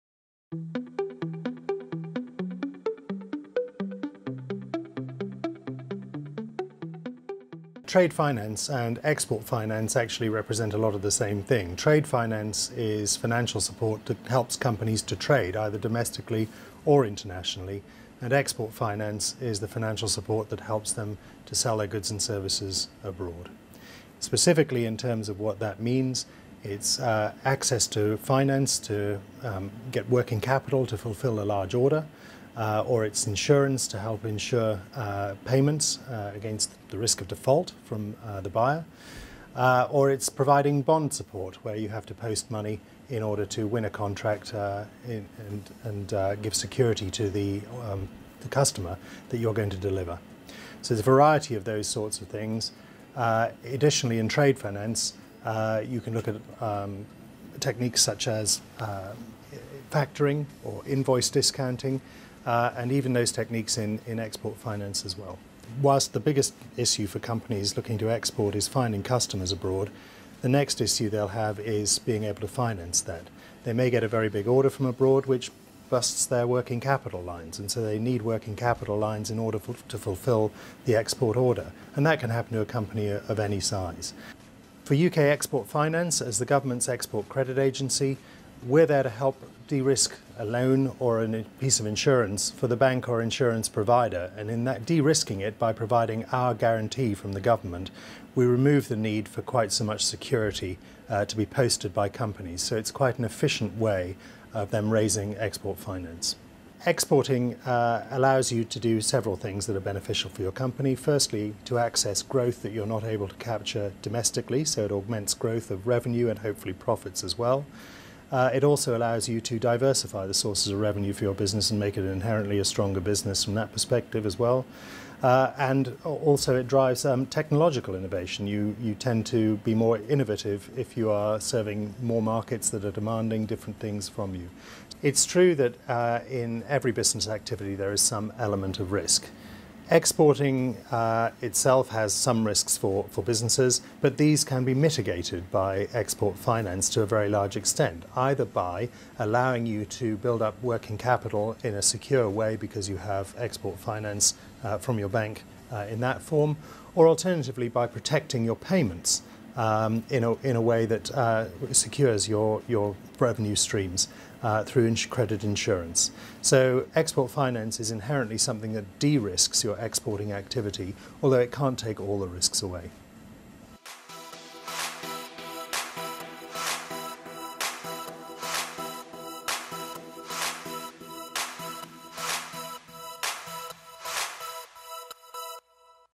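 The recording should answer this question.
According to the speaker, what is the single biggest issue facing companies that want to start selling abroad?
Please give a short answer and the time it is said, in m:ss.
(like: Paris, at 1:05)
Finding customers abroad, at 1:08.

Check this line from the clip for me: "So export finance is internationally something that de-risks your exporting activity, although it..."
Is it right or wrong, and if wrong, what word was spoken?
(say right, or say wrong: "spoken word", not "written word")
wrong: "inherently", not "internationally".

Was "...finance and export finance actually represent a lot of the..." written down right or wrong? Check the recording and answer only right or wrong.
right.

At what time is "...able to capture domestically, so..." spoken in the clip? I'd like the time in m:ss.
1:53.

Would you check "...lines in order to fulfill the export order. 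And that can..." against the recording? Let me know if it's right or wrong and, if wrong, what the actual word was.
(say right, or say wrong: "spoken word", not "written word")
right.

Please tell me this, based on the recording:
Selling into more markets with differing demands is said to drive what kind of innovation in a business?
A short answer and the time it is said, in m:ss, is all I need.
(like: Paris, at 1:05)
Technological innovation, at 2:07.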